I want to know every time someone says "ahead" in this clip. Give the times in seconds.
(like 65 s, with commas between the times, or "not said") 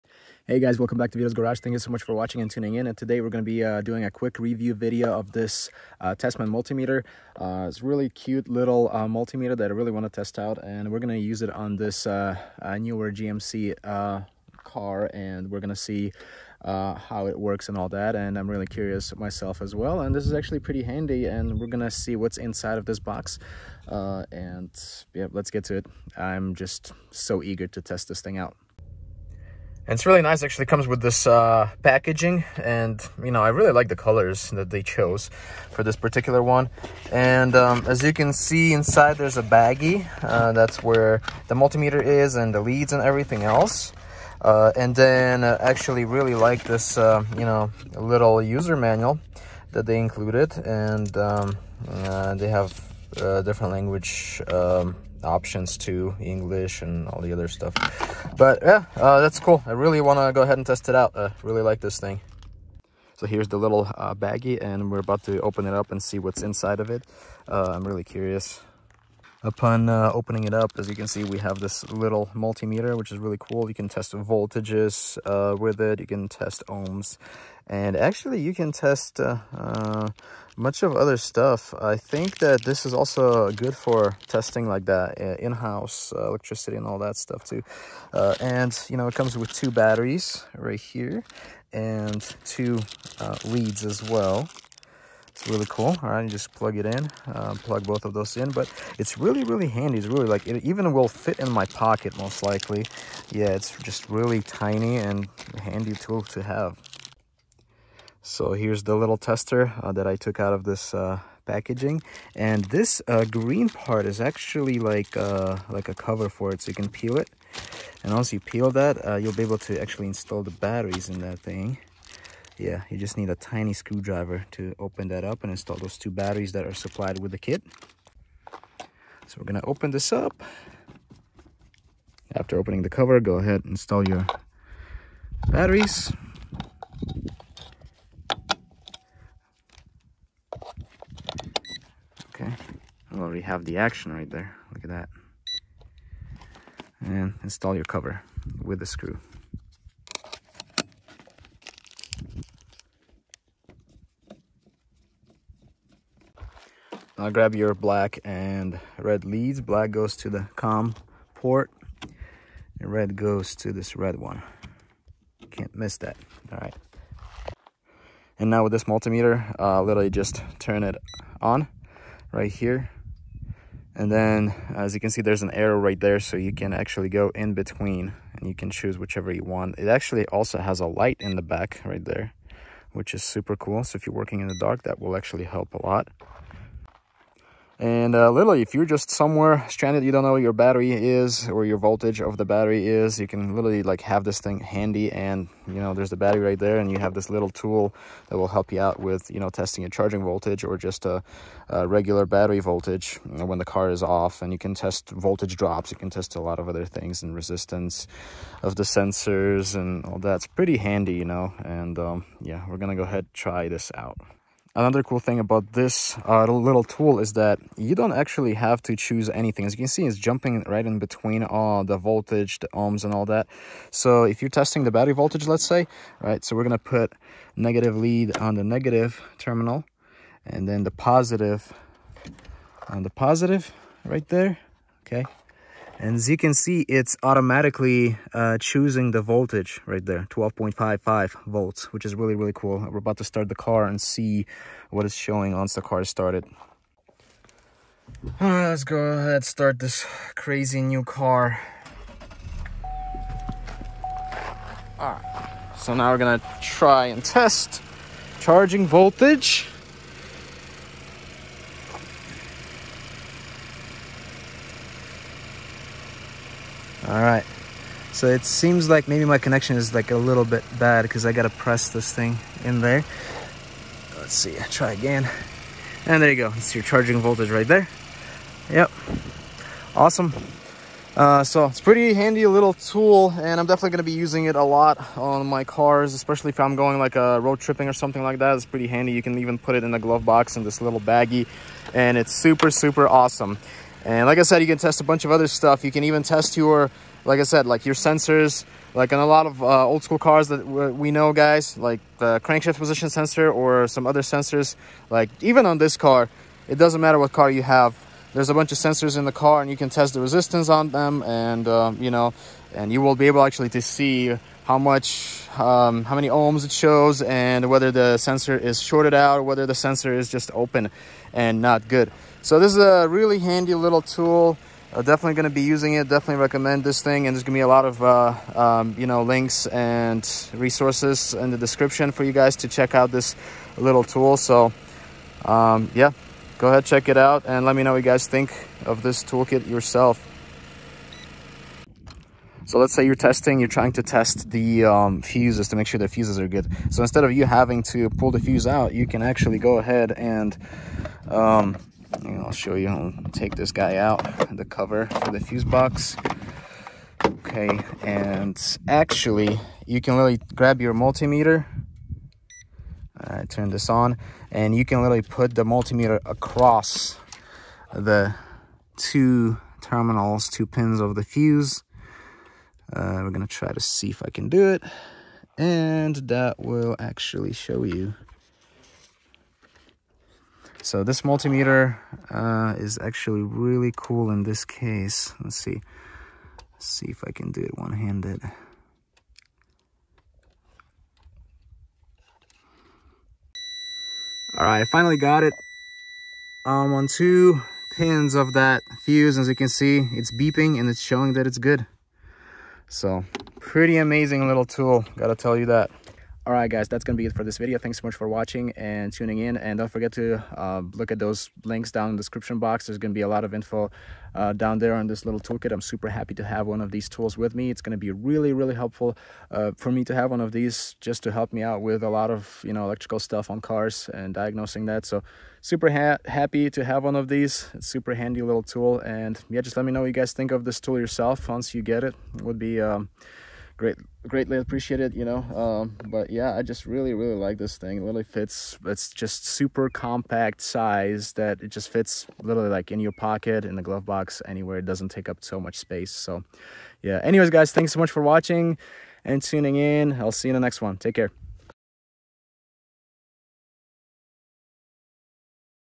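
60 s, 133 s, 213 s, 248 s, 336 s, 349 s.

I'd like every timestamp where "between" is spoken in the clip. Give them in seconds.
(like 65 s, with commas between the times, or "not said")
177 s, 220 s.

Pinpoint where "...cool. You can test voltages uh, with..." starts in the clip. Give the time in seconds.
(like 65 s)
73 s.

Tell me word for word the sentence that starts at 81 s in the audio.
I think that this is also good for testing like that, uh, in-house uh, electricity and all that stuff too.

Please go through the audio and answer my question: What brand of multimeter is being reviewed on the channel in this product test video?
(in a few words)
Tesmen.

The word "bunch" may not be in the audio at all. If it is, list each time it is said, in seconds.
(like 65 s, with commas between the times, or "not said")
295 s, 308 s.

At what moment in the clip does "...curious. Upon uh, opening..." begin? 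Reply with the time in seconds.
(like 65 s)
68 s.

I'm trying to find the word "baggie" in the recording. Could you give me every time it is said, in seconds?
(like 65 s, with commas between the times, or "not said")
39 s, 64 s, 291 s.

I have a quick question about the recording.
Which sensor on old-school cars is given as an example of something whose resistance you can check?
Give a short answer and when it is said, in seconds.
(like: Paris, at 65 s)
crankshaft position sensor, at 302 s.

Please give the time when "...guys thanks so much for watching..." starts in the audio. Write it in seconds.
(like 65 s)
447 s.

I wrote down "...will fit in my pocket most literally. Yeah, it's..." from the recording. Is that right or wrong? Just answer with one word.
wrong.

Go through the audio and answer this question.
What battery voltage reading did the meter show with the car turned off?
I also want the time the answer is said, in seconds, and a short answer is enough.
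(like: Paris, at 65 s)
12.55 volts, at 240 s.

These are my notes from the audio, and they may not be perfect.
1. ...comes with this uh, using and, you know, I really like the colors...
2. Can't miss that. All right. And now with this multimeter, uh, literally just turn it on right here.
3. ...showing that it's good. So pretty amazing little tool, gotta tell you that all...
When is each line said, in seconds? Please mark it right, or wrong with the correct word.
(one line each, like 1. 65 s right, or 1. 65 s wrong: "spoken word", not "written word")
1. 30 s wrong: "packaging", not "using"
2. 165 s right
3. 401 s right.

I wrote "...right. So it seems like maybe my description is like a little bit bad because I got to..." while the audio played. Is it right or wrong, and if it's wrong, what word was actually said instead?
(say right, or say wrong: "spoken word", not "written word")
wrong: "connection", not "description".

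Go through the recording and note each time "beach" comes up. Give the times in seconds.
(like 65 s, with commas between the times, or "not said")
not said.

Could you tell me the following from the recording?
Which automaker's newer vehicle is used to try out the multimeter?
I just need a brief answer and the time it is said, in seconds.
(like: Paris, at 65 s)
GMC, at 13 s.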